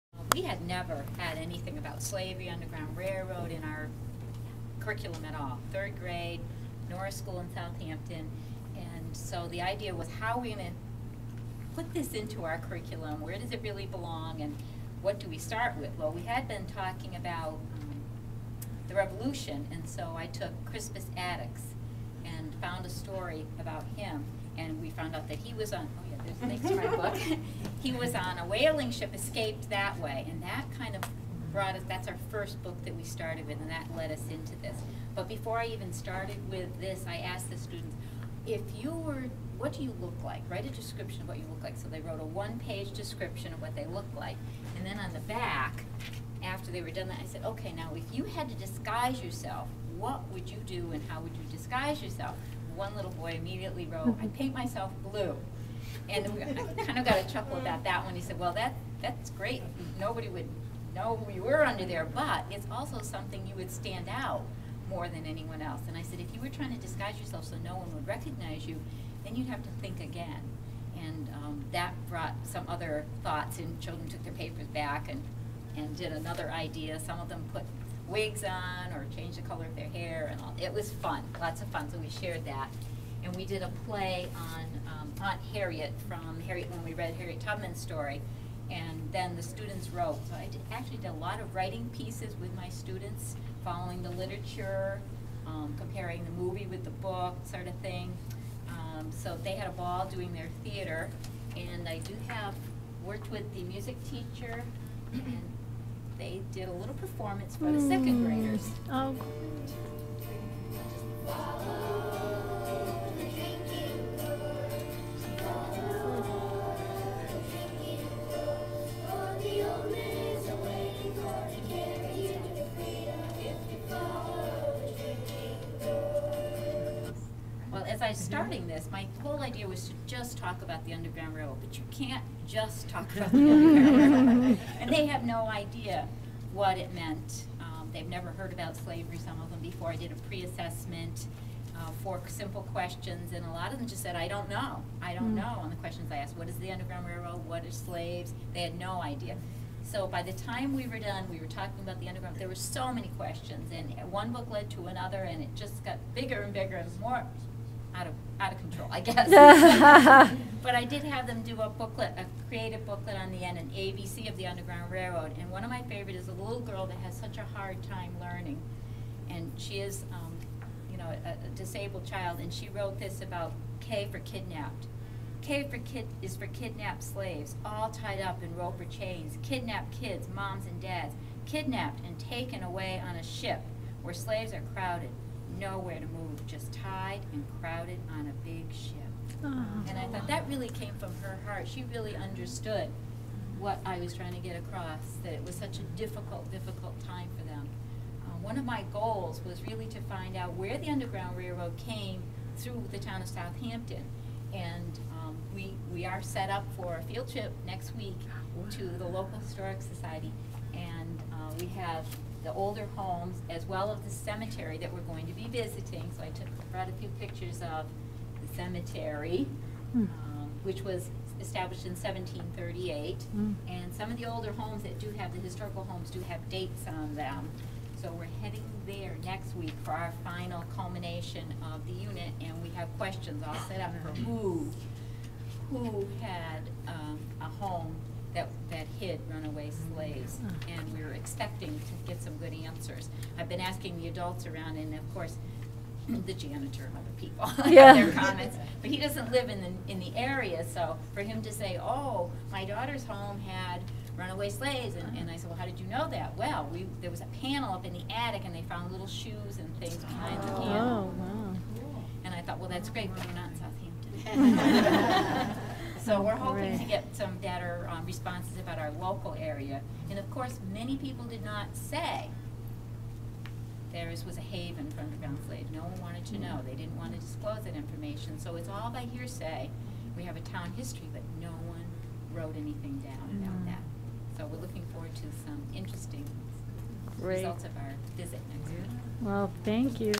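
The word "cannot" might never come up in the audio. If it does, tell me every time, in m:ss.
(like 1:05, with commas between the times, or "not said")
not said.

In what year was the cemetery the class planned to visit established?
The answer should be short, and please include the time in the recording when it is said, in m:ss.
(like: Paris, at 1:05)
1738, at 3:41.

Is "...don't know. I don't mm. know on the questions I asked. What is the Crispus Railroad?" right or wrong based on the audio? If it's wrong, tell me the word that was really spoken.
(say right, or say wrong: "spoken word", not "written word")
wrong: "Underground", not "Crispus".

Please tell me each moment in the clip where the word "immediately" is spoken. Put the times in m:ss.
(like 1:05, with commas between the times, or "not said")
0:53.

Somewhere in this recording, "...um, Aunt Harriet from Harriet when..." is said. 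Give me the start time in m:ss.
1:24.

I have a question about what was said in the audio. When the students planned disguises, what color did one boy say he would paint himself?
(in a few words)
Blue.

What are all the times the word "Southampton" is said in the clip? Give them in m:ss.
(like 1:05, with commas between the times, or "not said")
0:07, 3:23, 4:24.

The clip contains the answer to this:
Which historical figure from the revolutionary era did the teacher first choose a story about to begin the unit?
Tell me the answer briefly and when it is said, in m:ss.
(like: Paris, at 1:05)
Crispus Attucks, at 0:20.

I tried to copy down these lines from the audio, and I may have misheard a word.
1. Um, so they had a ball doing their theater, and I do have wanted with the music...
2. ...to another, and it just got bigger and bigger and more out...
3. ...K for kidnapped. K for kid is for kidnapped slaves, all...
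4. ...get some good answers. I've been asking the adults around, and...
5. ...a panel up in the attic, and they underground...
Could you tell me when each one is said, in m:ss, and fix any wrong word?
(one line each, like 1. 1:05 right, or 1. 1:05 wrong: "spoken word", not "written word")
1. 1:38 wrong: "worked", not "wanted"
2. 2:34 right
3. 2:53 right
4. 4:02 right
5. 4:17 wrong: "found", not "underground".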